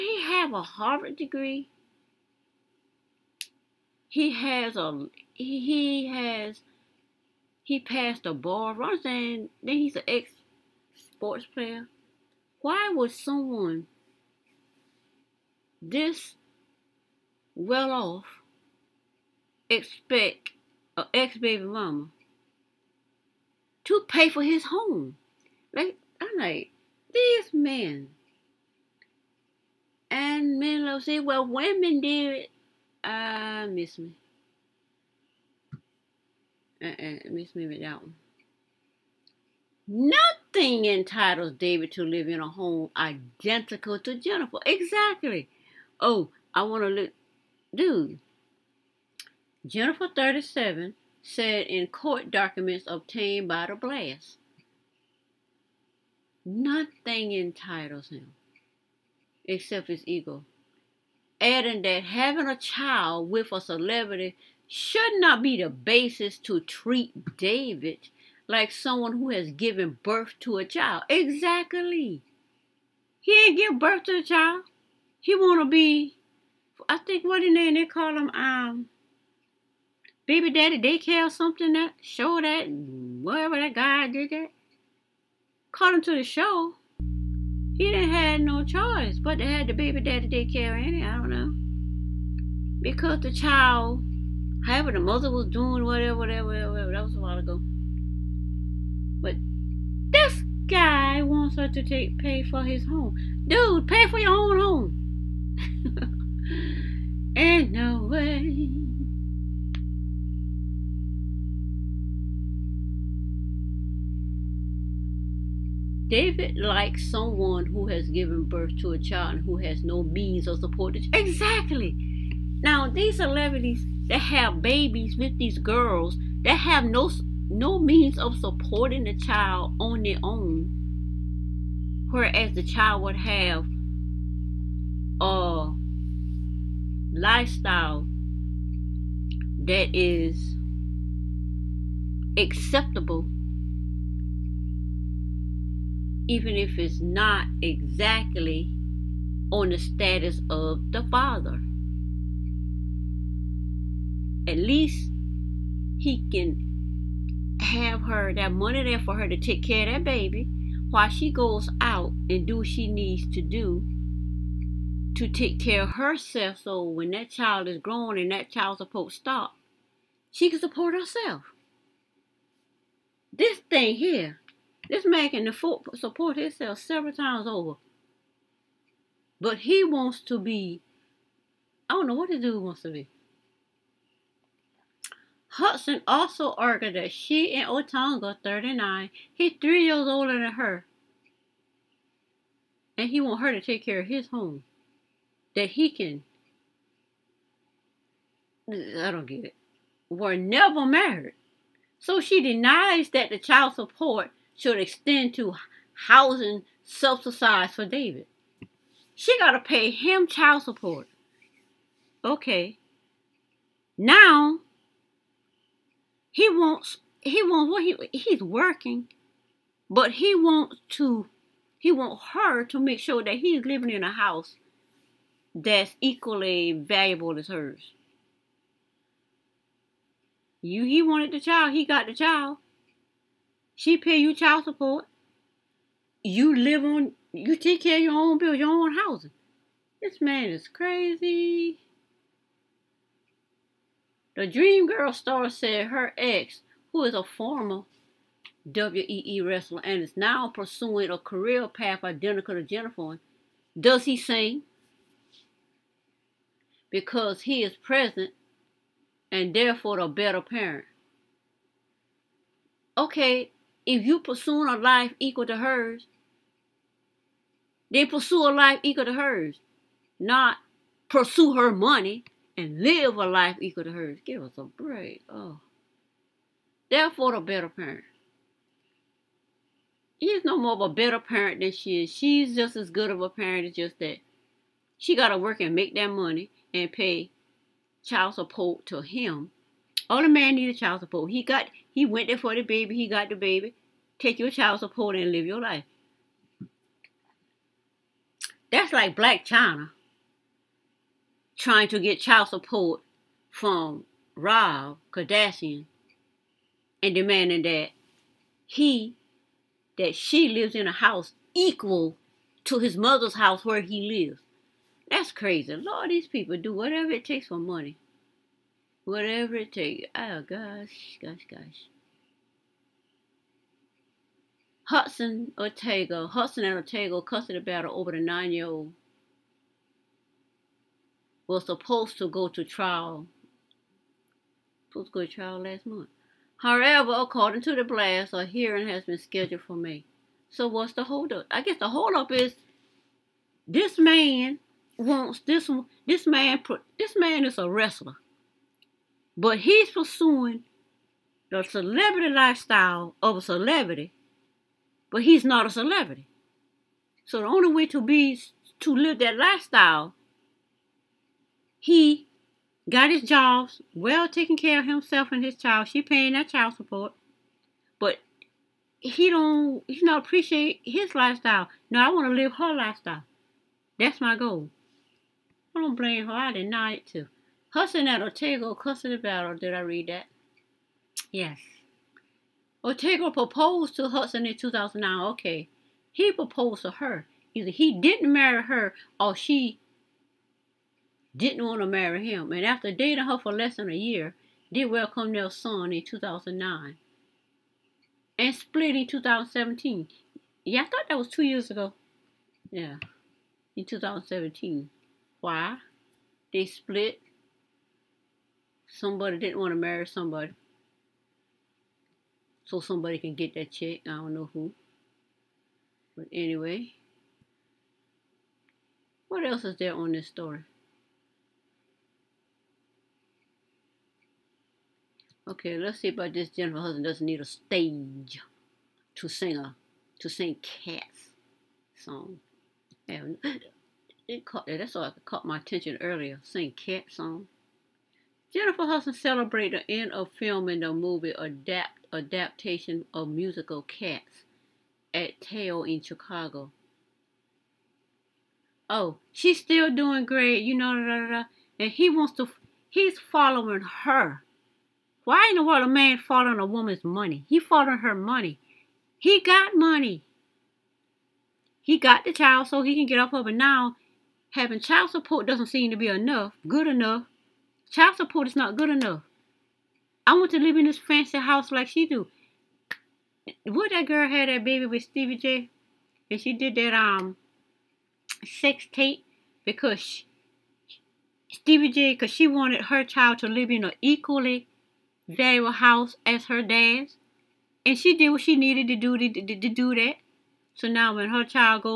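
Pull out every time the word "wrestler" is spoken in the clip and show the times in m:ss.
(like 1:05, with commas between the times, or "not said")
4:09, 5:47.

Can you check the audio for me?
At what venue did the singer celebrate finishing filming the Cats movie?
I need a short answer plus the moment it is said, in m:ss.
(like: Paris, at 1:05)
Tao, at 7:25.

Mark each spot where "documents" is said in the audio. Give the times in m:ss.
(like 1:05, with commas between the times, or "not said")
0:52.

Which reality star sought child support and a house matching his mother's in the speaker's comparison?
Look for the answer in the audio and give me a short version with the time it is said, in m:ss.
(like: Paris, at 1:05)
Rob Kardashian, at 5:04.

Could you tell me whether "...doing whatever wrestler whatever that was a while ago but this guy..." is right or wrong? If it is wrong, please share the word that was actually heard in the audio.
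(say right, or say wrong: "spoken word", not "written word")
wrong: "whatever", not "wrestler".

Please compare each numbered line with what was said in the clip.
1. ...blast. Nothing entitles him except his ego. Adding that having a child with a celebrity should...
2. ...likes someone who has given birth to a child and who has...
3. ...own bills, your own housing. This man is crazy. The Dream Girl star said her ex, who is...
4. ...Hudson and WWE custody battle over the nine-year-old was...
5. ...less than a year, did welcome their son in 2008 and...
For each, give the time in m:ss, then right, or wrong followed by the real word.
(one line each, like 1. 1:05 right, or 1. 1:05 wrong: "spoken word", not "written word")
1. 0:53 right
2. 1:56 right
3. 3:58 right
4. 5:26 wrong: "Otunga", not "WWE"
5. 6:33 wrong: "2009", not "2008".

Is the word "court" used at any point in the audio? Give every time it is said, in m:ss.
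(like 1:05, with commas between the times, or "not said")
0:51.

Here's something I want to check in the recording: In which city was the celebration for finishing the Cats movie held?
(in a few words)
Chicago.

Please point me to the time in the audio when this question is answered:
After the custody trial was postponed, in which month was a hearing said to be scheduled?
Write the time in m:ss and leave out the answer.
5:39.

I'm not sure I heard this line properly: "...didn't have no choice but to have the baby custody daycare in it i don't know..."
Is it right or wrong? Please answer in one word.
wrong.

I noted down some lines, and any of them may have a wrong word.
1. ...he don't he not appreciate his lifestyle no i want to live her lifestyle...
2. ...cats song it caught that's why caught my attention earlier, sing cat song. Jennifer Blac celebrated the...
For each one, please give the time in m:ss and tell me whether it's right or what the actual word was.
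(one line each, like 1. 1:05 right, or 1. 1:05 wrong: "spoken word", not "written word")
1. 6:08 right
2. 7:10 wrong: "Hudson", not "Blac".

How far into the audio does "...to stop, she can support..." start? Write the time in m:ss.
2:49.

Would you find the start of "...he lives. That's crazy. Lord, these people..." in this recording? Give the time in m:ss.
5:13.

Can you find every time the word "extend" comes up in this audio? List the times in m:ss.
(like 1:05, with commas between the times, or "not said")
3:24.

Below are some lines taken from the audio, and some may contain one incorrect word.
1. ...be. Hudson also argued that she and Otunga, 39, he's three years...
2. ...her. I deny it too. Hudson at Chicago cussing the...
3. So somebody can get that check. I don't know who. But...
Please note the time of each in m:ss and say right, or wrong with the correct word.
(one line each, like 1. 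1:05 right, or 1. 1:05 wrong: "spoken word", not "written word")
1. 3:02 right
2. 6:16 wrong: "Otunga", not "Chicago"
3. 6:52 right.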